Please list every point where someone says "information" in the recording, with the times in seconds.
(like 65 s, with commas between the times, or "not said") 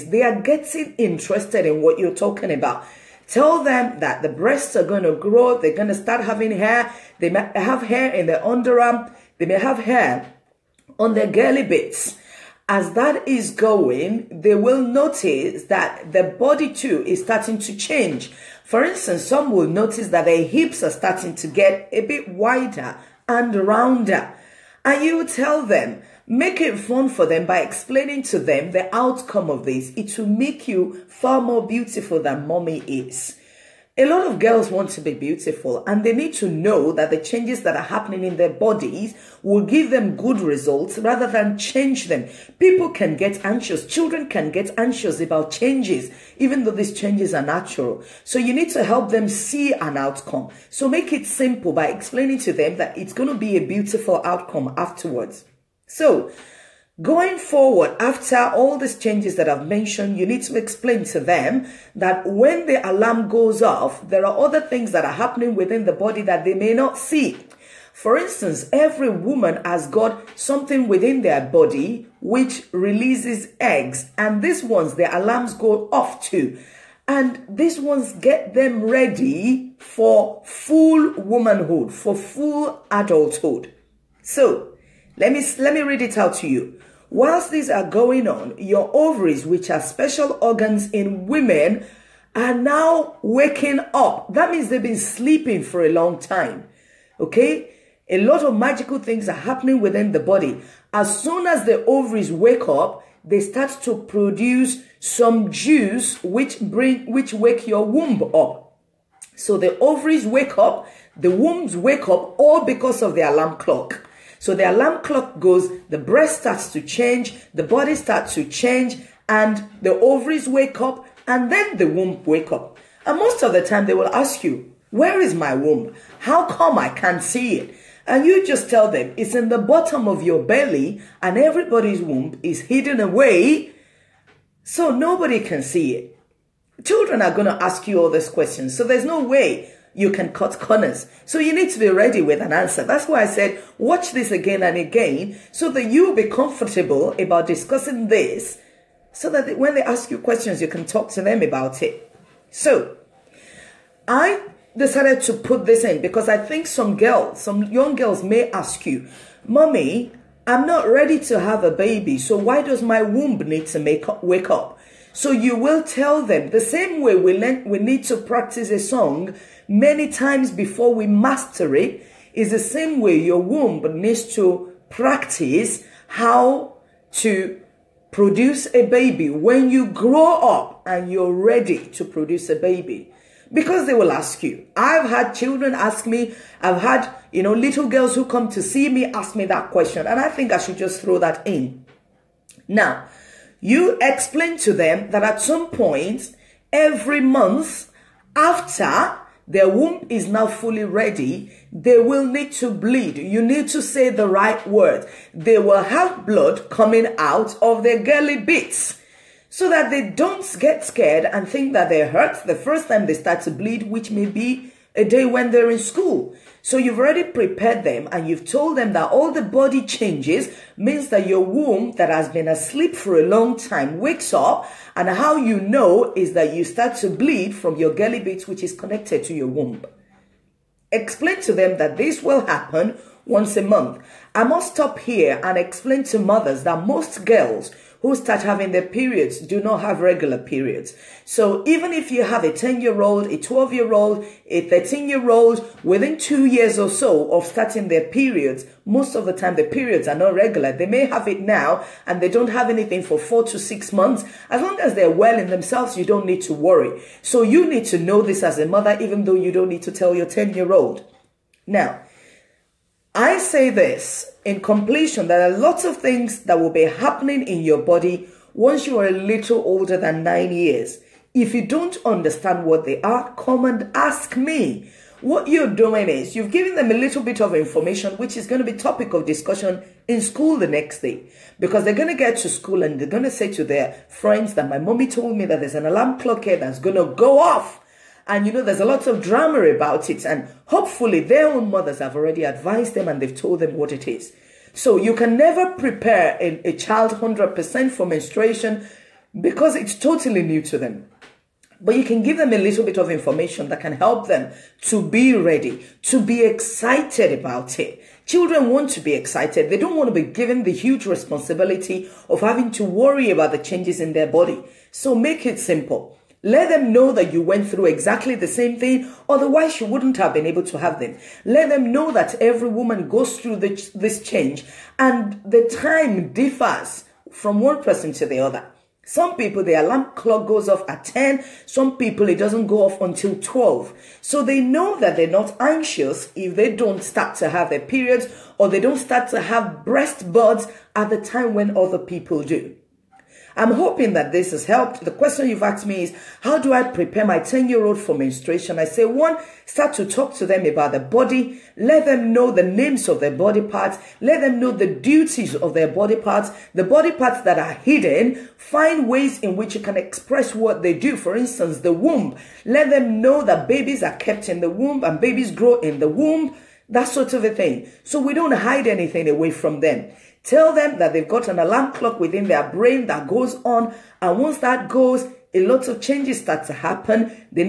277 s, 303 s.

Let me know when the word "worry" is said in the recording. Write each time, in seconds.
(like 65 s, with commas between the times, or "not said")
256 s, 312 s.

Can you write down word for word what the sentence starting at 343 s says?
I'm hoping that this has helped.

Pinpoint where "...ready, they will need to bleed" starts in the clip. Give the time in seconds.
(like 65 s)
200 s.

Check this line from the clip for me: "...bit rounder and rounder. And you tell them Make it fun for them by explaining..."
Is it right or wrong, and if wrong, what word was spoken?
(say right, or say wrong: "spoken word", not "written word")
wrong: "wider", not "rounder".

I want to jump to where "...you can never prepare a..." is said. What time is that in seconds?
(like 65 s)
294 s.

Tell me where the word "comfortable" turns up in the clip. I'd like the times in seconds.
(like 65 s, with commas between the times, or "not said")
146 s.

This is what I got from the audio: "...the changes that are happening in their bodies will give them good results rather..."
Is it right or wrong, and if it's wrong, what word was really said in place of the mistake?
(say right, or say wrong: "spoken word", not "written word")
right.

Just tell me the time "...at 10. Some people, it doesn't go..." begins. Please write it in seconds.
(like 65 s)
330 s.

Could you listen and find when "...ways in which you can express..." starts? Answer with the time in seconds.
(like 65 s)
359 s.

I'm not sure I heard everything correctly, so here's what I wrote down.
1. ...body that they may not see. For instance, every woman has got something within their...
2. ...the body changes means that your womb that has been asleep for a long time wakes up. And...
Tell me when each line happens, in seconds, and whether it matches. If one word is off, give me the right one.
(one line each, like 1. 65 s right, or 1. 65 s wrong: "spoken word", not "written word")
1. 65 s right
2. 219 s right.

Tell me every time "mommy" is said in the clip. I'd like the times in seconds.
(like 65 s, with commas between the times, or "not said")
32 s, 159 s, 284 s.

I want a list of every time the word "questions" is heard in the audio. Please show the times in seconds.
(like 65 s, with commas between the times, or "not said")
138 s, 150 s, 189 s, 345 s.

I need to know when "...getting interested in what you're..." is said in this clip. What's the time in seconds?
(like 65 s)
0 s.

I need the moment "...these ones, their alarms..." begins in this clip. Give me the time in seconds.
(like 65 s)
74 s.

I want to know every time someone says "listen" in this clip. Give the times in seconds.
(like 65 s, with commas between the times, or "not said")
not said.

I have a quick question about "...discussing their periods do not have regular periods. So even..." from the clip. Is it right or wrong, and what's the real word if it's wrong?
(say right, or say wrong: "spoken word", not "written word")
wrong: "having", not "discussing".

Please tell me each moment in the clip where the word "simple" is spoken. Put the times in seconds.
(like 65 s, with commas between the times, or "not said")
51 s, 315 s.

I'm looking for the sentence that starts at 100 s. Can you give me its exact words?
As soon as the ovaries wake up, they start to produce some juice which bring which wake your womb up.